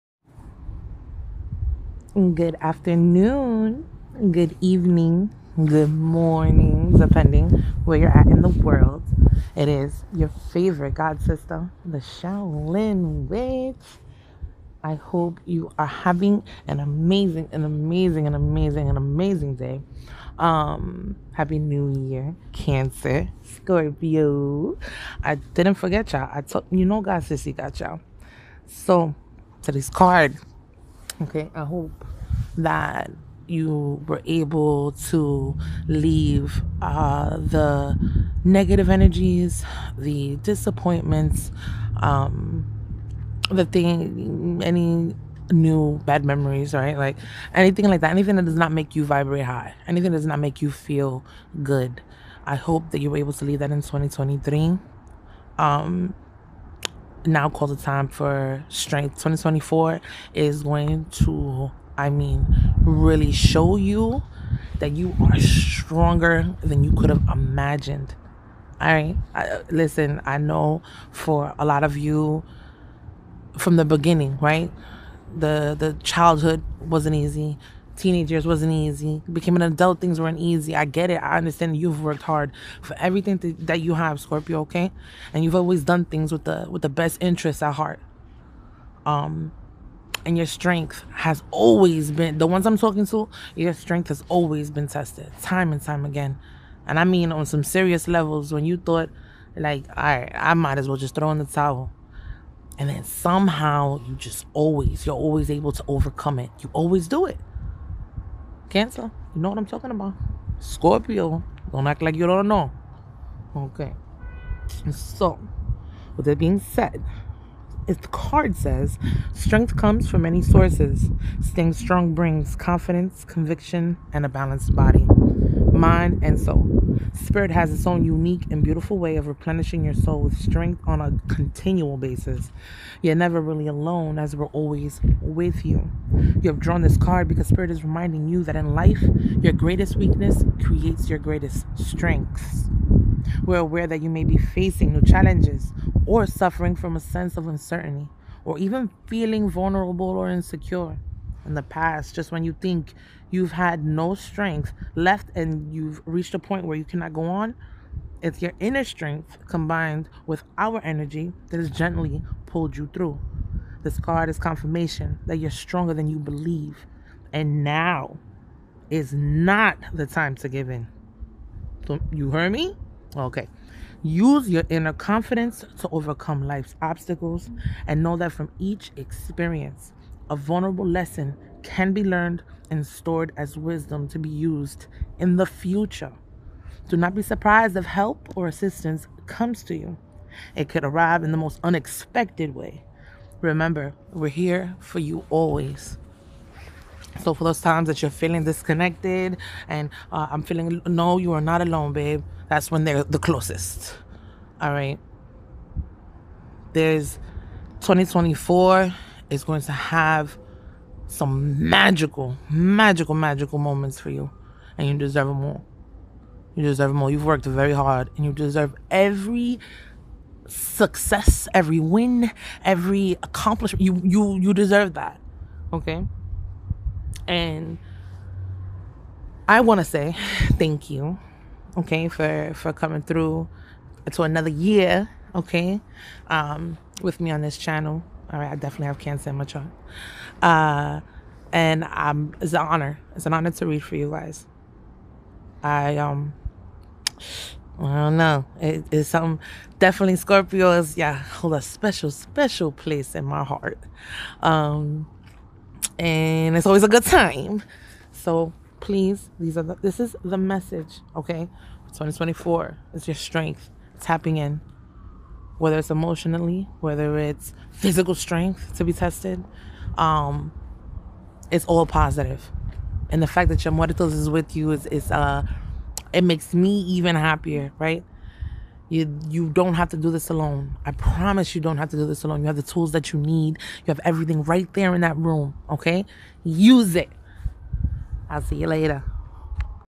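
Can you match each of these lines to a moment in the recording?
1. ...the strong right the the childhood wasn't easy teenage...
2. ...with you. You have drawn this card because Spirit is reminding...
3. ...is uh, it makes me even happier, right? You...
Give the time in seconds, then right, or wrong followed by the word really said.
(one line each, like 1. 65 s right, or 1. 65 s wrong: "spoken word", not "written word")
1. 73 s wrong: "beginning", not "strong"
2. 135 s right
3. 274 s right.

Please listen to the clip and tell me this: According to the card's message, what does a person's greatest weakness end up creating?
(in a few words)
Greatest strengths.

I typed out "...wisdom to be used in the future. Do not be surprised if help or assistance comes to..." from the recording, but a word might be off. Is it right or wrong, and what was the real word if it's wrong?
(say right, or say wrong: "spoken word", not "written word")
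right.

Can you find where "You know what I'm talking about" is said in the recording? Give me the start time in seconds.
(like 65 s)
109 s.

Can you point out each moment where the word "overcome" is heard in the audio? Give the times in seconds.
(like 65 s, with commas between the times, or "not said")
105 s, 175 s.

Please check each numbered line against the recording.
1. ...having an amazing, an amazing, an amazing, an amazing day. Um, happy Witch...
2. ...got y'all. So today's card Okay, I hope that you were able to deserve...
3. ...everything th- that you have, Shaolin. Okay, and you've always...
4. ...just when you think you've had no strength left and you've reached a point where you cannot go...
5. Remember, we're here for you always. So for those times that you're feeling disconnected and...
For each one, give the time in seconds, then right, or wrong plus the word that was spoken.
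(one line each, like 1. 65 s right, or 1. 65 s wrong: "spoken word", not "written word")
1. 15 s wrong: "New", not "Witch"
2. 27 s wrong: "leave", not "deserve"
3. 82 s wrong: "Scorpio", not "Shaolin"
4. 152 s right
5. 193 s right.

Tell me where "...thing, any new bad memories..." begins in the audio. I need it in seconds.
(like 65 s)
43 s.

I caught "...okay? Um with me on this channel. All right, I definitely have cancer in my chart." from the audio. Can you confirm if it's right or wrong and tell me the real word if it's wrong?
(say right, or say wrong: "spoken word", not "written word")
right.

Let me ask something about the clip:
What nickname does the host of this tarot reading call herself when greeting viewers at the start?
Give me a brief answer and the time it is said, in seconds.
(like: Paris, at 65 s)
The Shaolin Witch, at 11 s.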